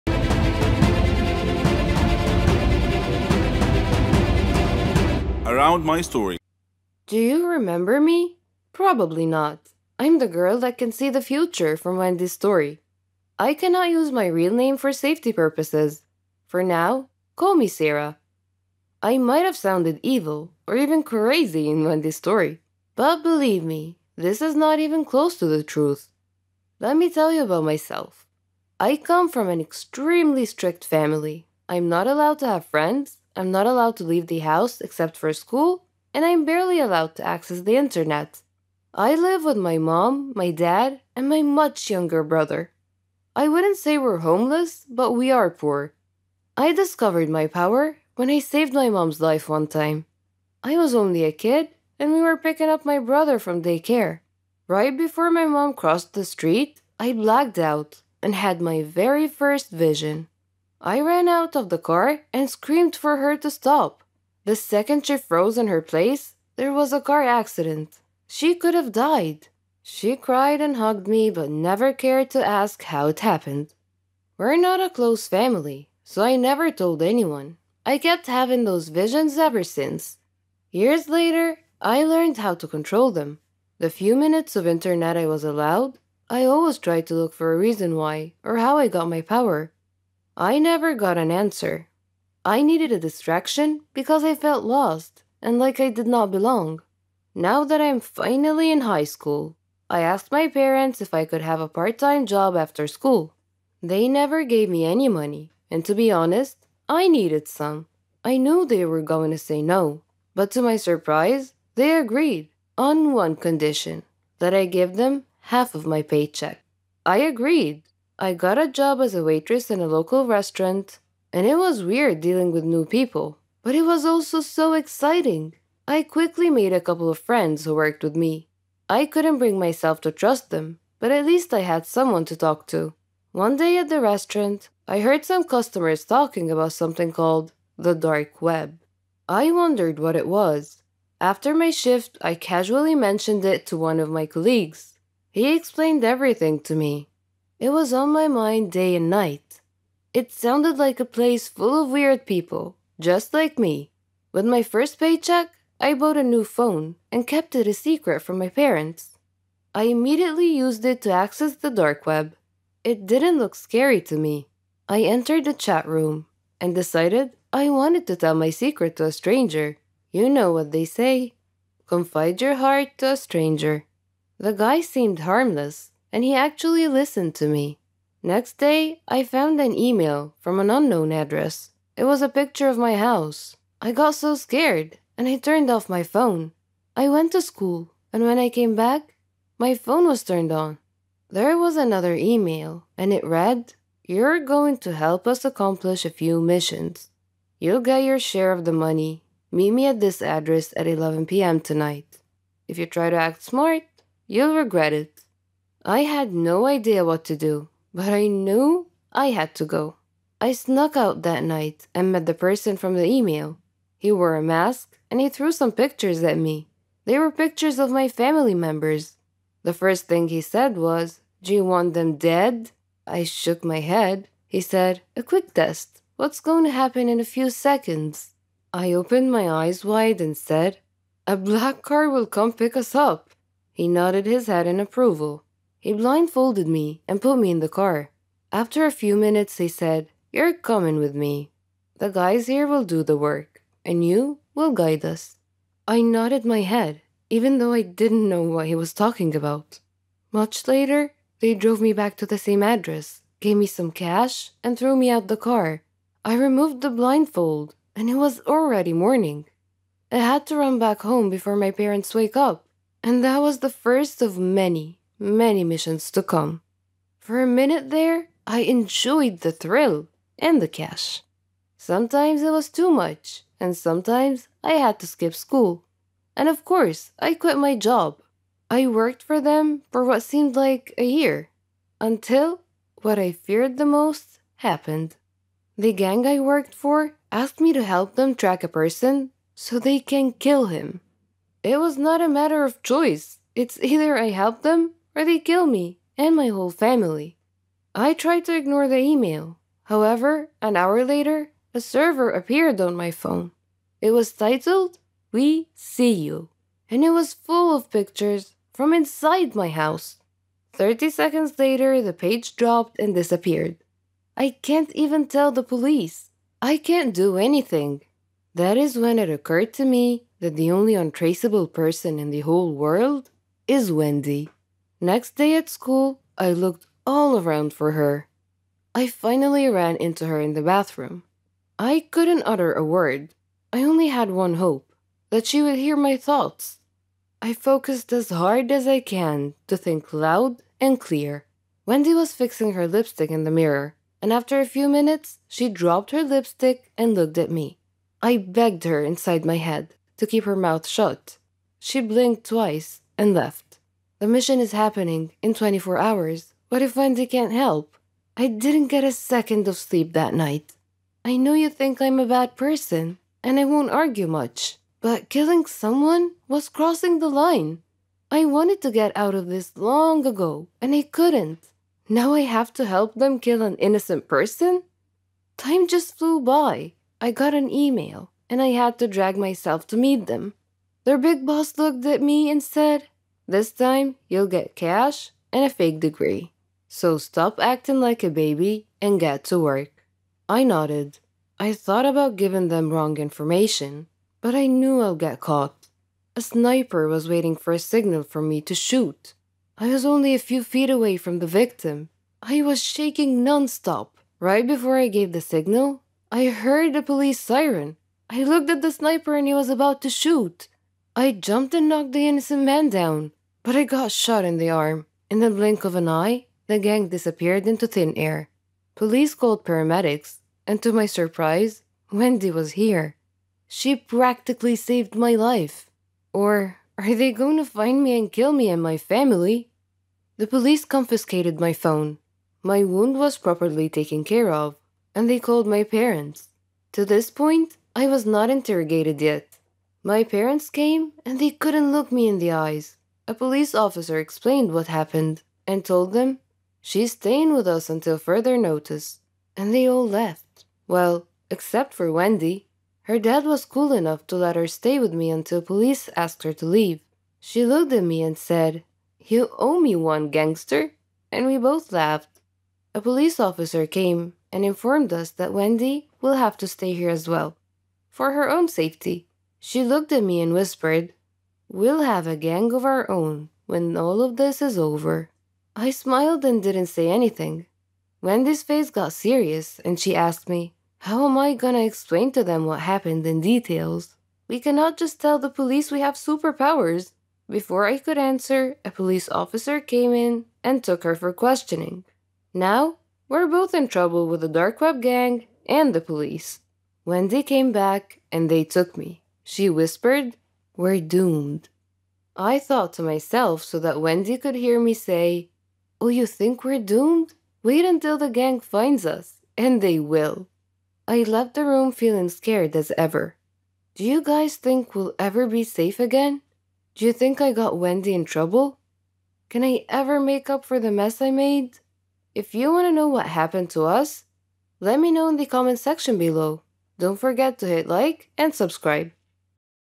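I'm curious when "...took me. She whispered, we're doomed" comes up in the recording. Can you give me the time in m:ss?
8:18.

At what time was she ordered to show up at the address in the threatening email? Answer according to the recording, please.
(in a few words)
11 p.m.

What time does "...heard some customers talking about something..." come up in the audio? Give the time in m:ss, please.
2:14.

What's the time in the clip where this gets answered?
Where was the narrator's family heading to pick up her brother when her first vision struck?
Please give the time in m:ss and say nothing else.
0:53.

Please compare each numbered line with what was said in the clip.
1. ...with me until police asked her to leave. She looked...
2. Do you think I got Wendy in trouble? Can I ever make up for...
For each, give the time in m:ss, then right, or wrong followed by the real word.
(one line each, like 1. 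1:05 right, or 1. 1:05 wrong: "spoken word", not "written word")
1. 7:34 right
2. 8:36 right.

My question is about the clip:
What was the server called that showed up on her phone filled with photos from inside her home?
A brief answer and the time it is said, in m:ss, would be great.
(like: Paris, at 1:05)
We See You, at 5:05.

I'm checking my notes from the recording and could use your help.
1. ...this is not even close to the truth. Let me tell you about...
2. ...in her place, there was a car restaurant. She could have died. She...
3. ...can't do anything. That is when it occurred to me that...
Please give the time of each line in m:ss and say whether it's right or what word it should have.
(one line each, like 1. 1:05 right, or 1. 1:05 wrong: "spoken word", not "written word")
1. 0:24 right
2. 1:05 wrong: "accident", not "restaurant"
3. 5:16 right.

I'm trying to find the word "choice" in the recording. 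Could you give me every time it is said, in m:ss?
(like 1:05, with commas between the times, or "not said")
4:52.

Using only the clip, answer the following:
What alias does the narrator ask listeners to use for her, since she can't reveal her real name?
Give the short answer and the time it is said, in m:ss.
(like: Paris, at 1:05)
Sarah, at 0:17.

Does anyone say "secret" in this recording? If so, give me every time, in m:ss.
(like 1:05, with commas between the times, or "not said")
2:37, 2:48.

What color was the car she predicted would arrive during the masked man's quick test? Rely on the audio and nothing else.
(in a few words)
black.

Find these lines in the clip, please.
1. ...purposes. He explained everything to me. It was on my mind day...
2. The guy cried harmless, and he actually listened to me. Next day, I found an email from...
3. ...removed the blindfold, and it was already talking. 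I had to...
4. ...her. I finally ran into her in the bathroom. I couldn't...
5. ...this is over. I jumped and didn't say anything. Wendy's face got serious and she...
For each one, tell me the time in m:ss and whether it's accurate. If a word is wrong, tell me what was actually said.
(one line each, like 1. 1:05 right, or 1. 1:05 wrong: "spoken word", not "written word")
1. 2:24 wrong: "colleagues", not "purposes"
2. 2:54 wrong: "seemed", not "cried"
3. 4:16 wrong: "morning", not "talking"
4. 5:27 right
5. 7:54 wrong: "smiled", not "jumped".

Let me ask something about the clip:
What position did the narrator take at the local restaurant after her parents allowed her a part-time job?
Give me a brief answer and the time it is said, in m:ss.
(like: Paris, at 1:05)
waitress, at 1:59.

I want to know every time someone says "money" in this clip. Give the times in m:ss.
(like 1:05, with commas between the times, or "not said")
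1:45, 3:18.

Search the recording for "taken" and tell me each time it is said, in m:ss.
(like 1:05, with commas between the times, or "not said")
7:13.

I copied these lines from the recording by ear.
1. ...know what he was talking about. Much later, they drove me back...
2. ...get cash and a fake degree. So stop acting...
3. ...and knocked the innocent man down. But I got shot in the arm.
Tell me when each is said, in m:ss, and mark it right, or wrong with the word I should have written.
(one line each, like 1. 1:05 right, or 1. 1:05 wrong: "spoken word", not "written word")
1. 4:08 right
2. 6:24 right
3. 6:51 right.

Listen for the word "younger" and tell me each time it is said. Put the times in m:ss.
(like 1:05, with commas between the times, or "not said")
0:41.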